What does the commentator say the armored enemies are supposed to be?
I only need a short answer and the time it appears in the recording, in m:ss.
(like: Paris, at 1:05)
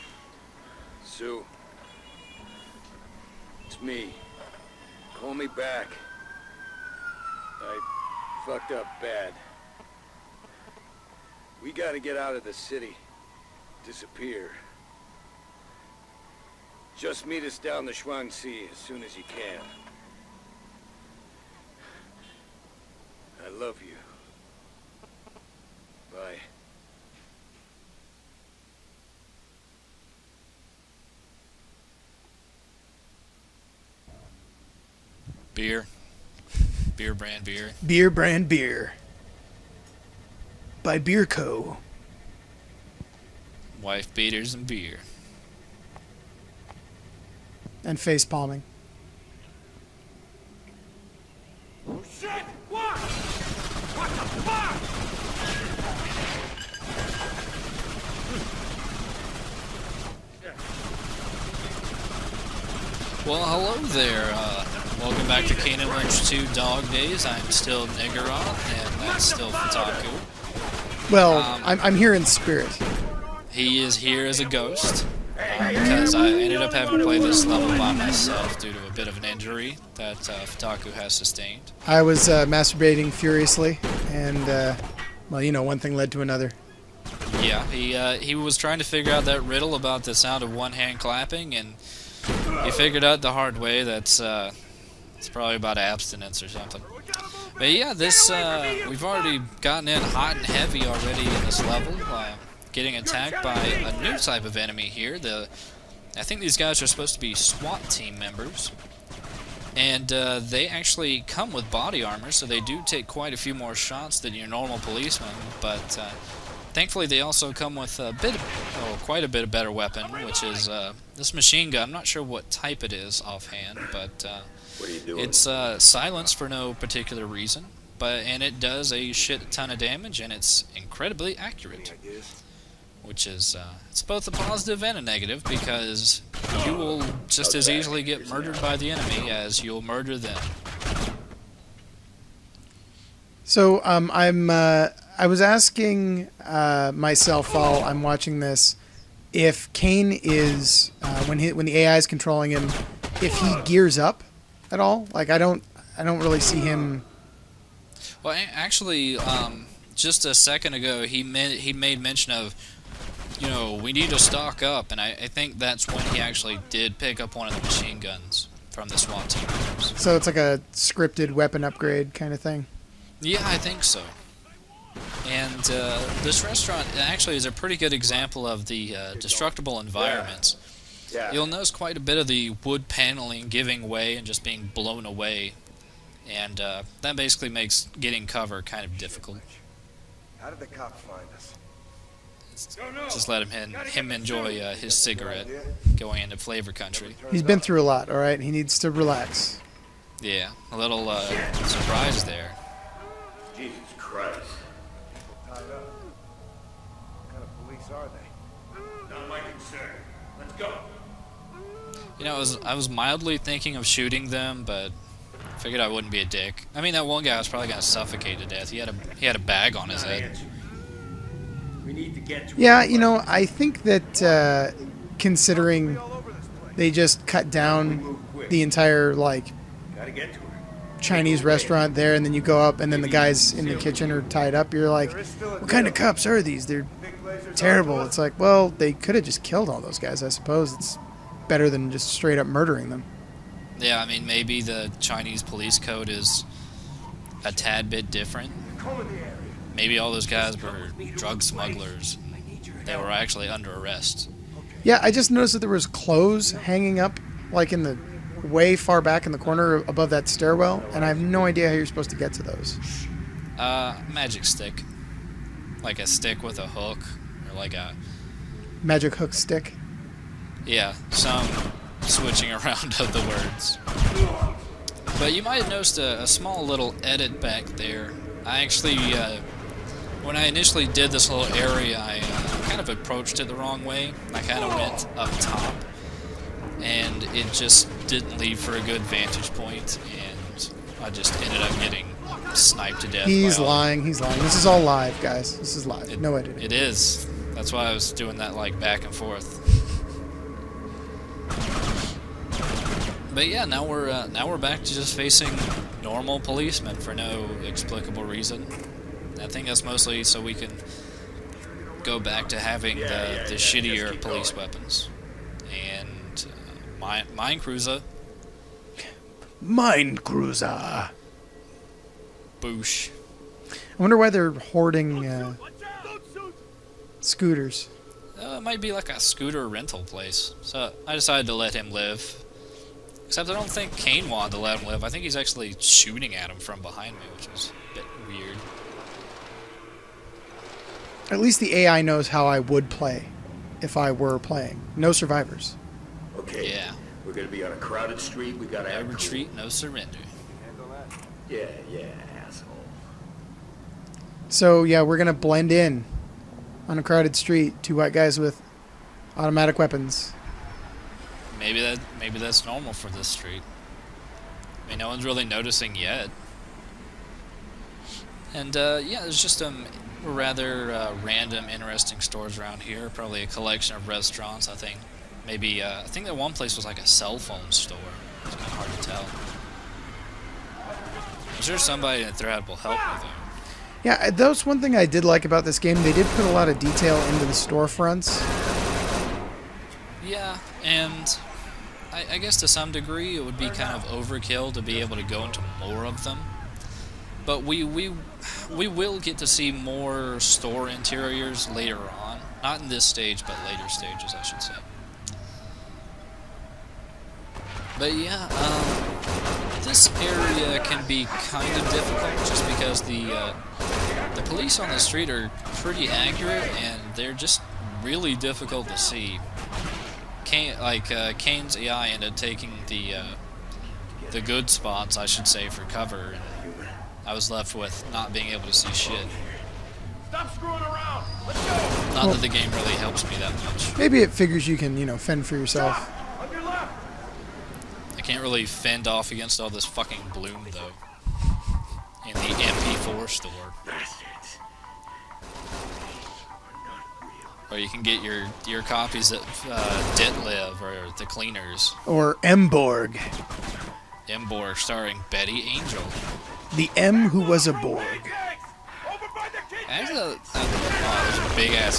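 SWAT team members, at 1:47.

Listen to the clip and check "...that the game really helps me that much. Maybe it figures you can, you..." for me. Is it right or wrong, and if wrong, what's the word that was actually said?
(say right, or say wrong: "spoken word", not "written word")
right.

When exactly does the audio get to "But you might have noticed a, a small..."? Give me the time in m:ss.
4:35.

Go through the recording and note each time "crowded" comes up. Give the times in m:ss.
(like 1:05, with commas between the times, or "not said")
5:47, 5:57.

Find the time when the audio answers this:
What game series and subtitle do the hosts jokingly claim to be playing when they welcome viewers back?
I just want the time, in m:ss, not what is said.
1:05.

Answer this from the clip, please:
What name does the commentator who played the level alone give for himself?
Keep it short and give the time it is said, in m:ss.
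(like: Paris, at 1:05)
Negaroth, at 1:07.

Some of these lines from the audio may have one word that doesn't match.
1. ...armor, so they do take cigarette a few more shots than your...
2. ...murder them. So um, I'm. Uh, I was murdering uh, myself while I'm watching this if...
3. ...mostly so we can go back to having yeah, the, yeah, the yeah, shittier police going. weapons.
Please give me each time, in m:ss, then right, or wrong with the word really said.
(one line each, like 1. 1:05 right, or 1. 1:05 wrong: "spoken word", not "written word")
1. 1:52 wrong: "quite", not "cigarette"
2. 2:19 wrong: "asking", not "murdering"
3. 5:09 right.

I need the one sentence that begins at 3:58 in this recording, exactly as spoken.
It's like, well, they could have just killed all those guys.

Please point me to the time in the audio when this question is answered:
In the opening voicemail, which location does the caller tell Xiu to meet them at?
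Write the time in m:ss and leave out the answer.
0:17.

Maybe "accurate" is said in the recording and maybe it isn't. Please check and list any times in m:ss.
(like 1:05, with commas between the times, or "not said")
2:11, 6:56.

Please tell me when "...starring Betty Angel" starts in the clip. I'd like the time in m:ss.
7:34.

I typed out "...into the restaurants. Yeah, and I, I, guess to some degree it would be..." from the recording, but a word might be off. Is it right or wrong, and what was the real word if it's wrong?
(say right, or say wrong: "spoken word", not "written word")
wrong: "storefronts", not "restaurants".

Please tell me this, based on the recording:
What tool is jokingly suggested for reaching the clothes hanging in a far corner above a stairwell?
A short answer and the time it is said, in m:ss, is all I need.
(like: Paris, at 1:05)
magic hook stick, at 4:28.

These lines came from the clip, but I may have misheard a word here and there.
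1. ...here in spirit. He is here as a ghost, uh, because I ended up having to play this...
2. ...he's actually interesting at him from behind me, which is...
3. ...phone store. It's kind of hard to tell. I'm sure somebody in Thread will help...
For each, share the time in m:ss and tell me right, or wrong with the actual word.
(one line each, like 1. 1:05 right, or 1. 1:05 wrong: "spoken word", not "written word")
1. 1:11 right
2. 5:35 wrong: "shooting", not "interesting"
3. 6:17 right.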